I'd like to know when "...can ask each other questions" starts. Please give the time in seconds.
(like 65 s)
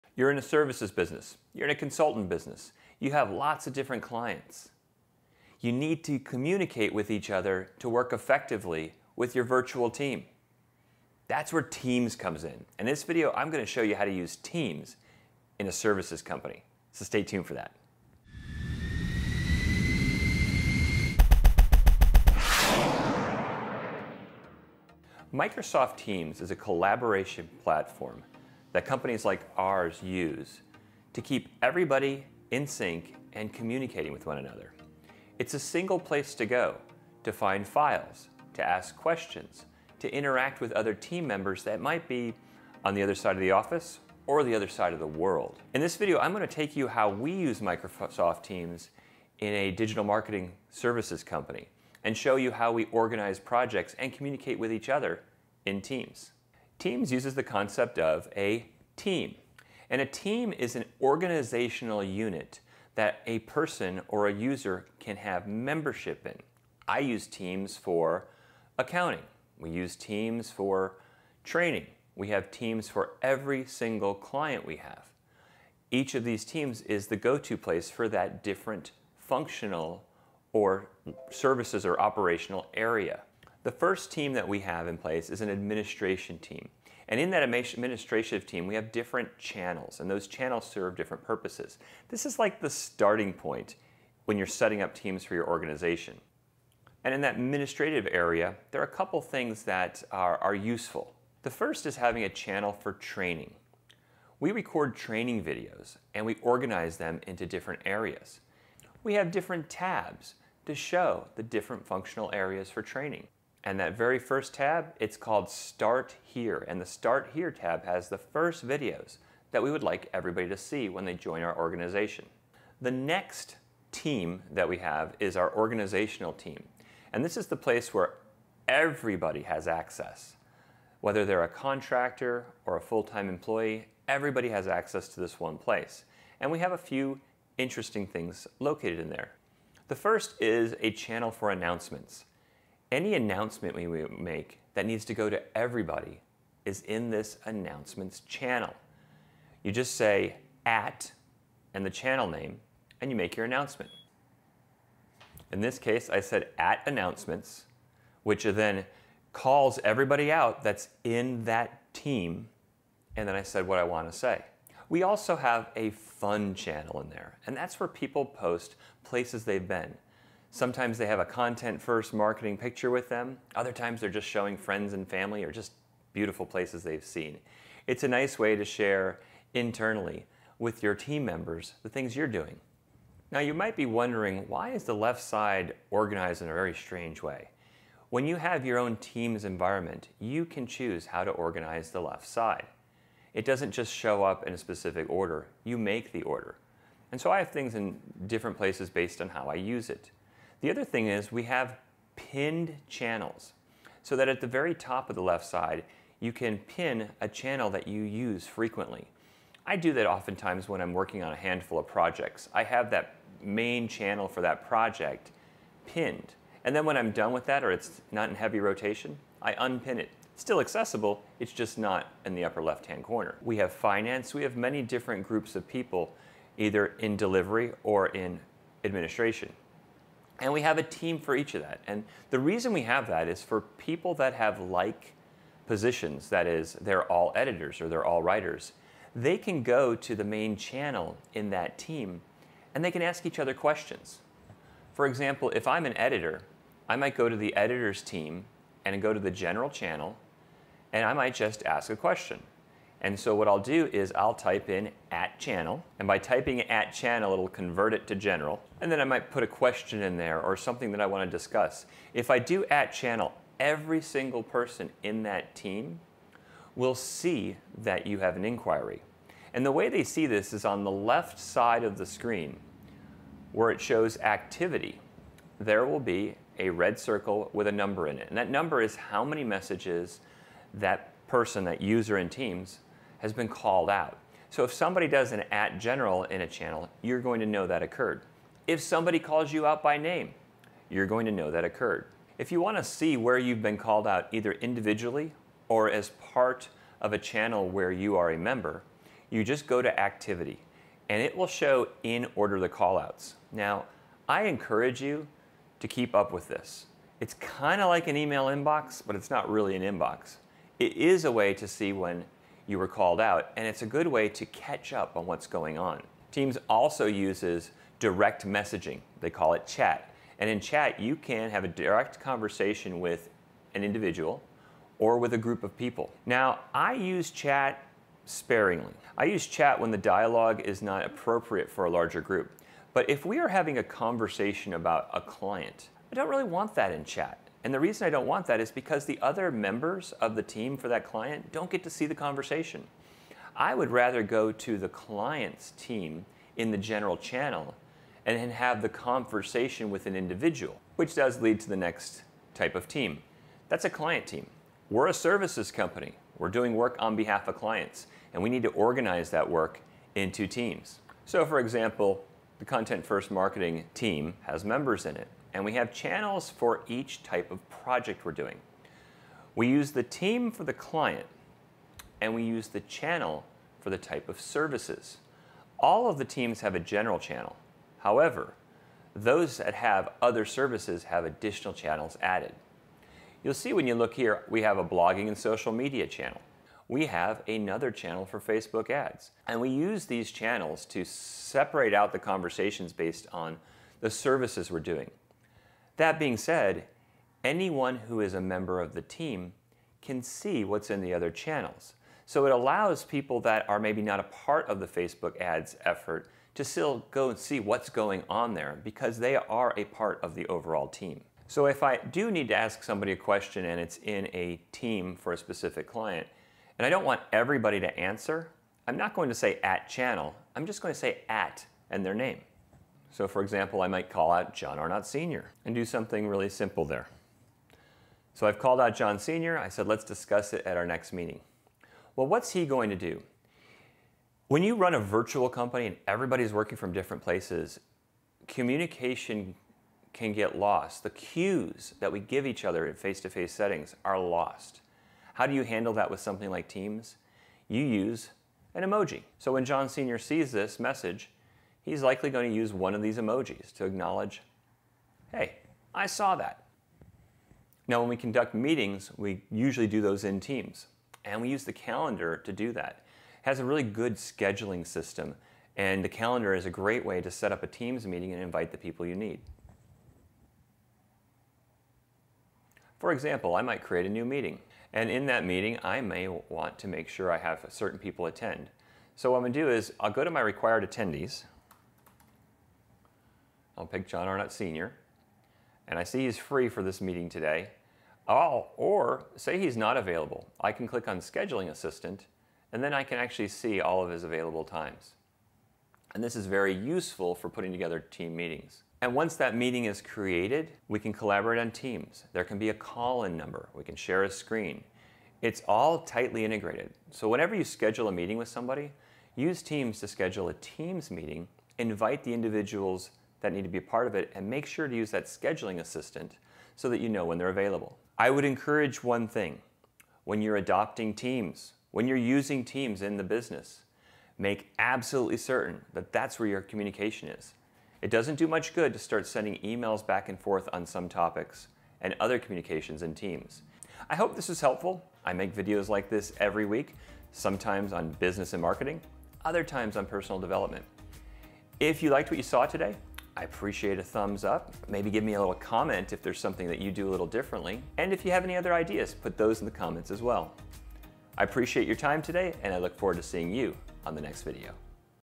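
242 s.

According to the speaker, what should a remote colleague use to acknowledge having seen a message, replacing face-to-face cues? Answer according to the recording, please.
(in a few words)
an emoji.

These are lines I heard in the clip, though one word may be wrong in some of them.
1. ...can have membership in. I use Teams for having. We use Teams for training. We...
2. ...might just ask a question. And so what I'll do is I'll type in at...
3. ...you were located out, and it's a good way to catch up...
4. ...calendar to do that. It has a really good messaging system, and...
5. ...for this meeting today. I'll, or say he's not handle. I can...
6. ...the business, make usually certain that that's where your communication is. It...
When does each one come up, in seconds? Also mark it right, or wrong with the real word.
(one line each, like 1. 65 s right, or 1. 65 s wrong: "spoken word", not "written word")
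1. 64 s wrong: "accounting", not "having"
2. 251 s right
3. 312 s wrong: "called", not "located"
4. 461 s wrong: "scheduling", not "messaging"
5. 486 s wrong: "available", not "handle"
6. 523 s wrong: "absolutely", not "usually".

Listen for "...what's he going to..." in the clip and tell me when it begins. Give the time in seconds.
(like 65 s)
432 s.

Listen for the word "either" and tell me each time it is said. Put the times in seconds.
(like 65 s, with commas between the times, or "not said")
226 s, 294 s.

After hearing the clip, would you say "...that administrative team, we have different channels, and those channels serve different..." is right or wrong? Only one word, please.
right.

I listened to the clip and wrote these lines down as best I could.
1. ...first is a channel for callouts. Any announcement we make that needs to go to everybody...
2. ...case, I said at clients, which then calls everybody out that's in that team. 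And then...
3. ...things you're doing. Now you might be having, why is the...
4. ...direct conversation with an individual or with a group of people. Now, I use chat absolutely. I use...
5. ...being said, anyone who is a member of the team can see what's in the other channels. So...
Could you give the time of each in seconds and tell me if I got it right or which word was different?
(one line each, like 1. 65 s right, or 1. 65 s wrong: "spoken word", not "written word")
1. 139 s wrong: "announcements", not "callouts"
2. 155 s wrong: "announcements", not "clients"
3. 181 s wrong: "wondering", not "having"
4. 321 s wrong: "sparingly", not "absolutely"
5. 396 s right.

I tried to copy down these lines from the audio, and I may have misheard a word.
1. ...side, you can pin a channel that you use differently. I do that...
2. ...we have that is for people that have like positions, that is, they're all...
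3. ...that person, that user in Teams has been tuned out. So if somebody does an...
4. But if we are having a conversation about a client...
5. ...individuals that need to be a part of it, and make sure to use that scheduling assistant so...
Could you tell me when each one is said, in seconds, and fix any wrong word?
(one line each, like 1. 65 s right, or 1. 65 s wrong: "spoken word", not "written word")
1. 205 s wrong: "frequently", not "differently"
2. 232 s right
3. 280 s wrong: "called", not "tuned"
4. 332 s right
5. 512 s right.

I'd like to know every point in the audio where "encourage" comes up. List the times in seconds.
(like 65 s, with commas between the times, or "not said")
304 s, 518 s.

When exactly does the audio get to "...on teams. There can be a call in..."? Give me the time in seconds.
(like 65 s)
501 s.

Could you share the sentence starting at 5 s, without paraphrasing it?
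You need to communicate with each other to work effectively with your virtual team.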